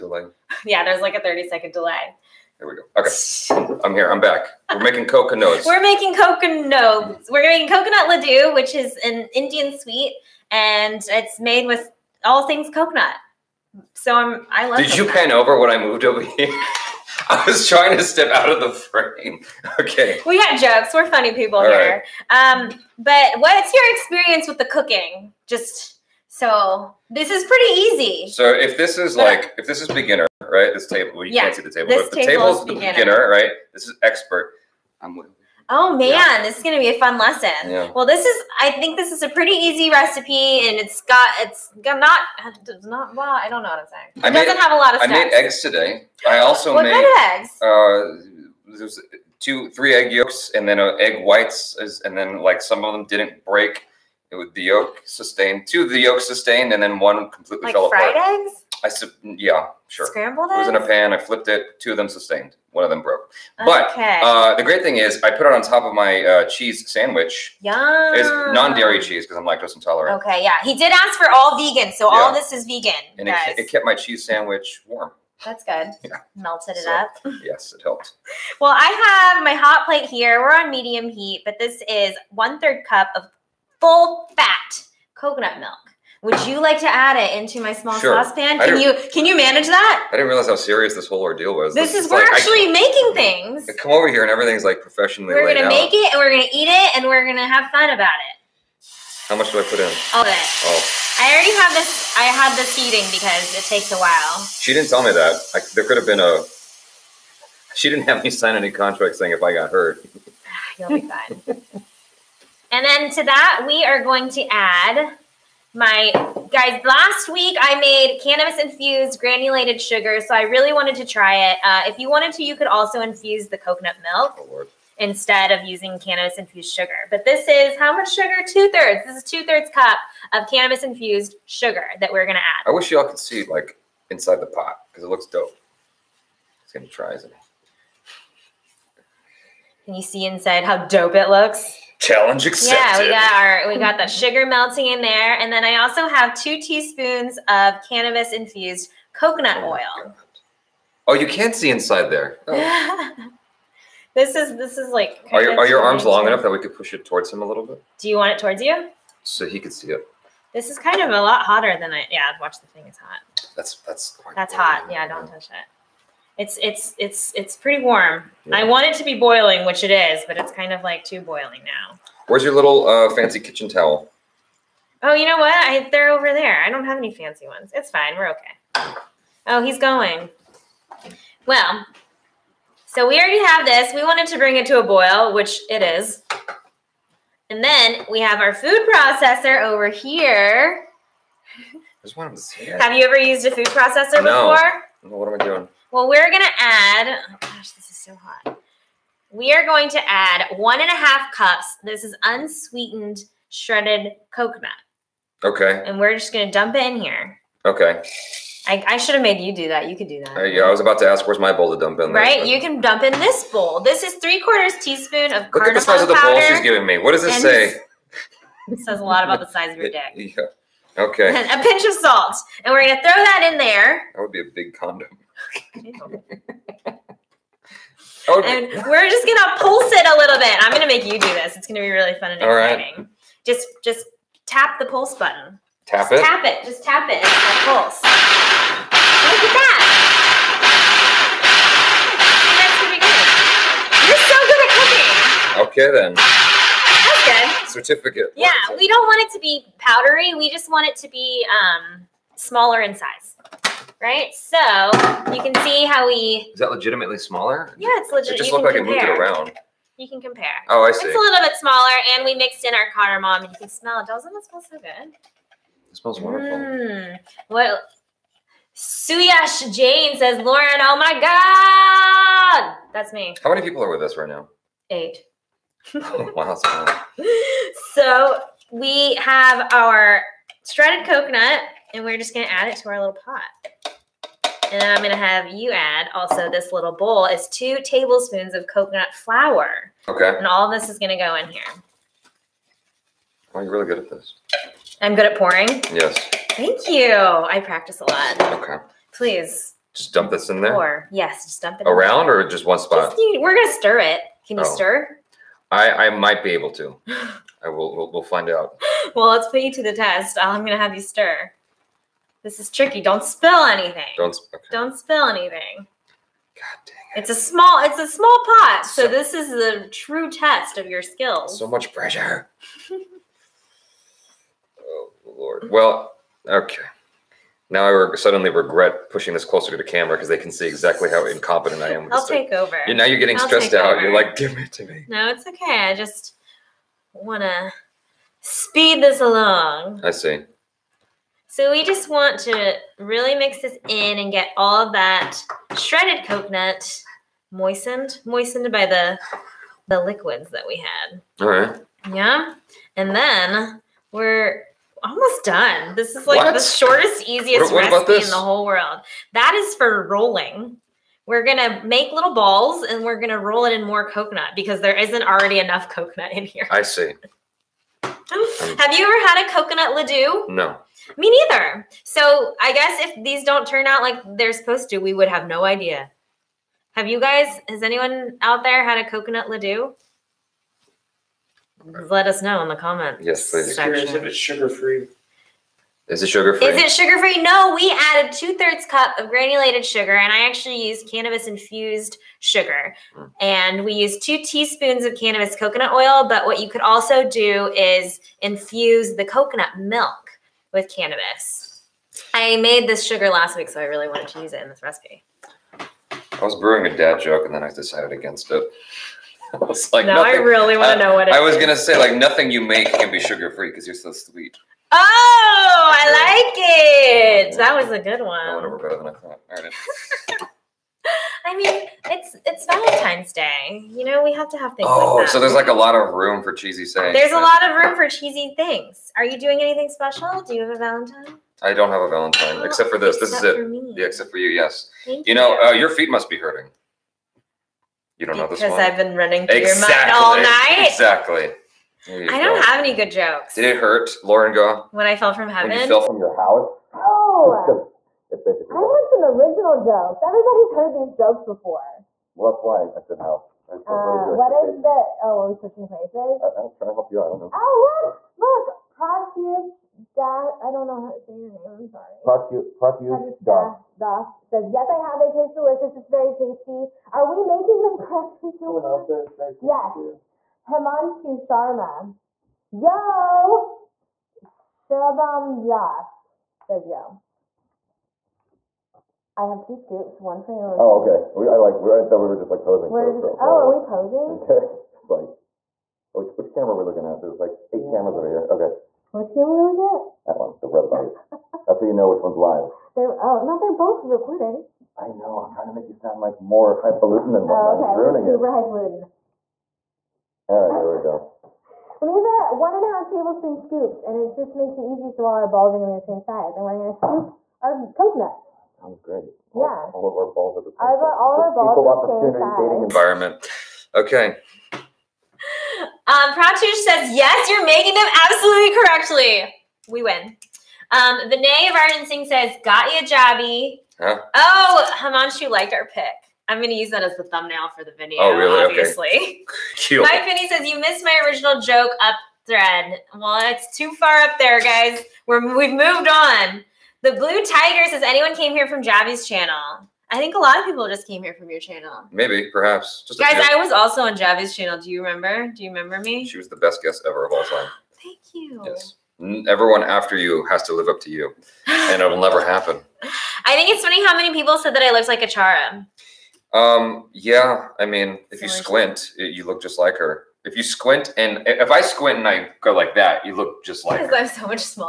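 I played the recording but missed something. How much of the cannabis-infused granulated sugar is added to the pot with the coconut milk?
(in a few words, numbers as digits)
2/3 cup.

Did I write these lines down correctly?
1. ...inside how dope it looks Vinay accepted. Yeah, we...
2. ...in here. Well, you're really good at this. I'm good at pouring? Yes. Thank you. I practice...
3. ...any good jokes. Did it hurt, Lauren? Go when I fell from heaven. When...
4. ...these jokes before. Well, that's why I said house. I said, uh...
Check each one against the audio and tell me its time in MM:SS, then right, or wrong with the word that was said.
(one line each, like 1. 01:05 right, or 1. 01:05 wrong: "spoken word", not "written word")
1. 02:20 wrong: "Challenge", not "Vinay"
2. 04:51 right
3. 07:22 right
4. 07:30 right.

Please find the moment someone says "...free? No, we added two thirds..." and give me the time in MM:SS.
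06:27.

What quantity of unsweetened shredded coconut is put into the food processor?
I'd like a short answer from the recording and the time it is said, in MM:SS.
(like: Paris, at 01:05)
1.5 cups, at 03:20.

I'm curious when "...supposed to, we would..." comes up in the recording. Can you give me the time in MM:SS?
06:14.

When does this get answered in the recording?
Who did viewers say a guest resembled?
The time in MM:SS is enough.
09:15.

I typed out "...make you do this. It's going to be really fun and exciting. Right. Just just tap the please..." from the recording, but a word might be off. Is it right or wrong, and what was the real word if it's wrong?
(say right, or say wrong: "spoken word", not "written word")
wrong: "pulse", not "please".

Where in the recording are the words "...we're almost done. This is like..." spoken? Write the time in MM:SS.
05:54.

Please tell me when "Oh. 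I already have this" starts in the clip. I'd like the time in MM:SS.
01:40.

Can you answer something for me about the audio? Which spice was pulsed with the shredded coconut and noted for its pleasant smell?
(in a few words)
cardamom.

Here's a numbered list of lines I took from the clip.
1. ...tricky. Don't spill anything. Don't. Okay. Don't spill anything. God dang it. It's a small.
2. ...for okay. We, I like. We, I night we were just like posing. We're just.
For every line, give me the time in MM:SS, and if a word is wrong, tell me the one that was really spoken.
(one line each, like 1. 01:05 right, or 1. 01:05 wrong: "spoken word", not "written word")
1. 05:12 right
2. 08:01 wrong: "thought", not "night".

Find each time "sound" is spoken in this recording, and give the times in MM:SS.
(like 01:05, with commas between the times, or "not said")
08:15, 08:28.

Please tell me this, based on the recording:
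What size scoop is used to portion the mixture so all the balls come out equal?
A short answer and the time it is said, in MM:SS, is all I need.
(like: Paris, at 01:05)
1.5 tablespoon, at 08:22.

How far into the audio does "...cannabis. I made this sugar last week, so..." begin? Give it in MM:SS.
06:40.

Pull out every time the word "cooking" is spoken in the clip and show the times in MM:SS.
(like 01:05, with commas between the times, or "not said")
00:24, 04:06.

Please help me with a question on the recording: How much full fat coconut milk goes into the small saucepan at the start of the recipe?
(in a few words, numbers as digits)
1/3 cup.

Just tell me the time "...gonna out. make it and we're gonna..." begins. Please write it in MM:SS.
01:35.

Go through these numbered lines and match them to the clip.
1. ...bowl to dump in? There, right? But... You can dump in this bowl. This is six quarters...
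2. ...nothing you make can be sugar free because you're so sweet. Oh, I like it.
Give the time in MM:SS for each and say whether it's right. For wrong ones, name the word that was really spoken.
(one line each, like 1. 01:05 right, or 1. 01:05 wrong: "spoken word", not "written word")
1. 03:31 wrong: "three", not "six"
2. 06:52 right.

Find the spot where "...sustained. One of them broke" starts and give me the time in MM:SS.
01:02.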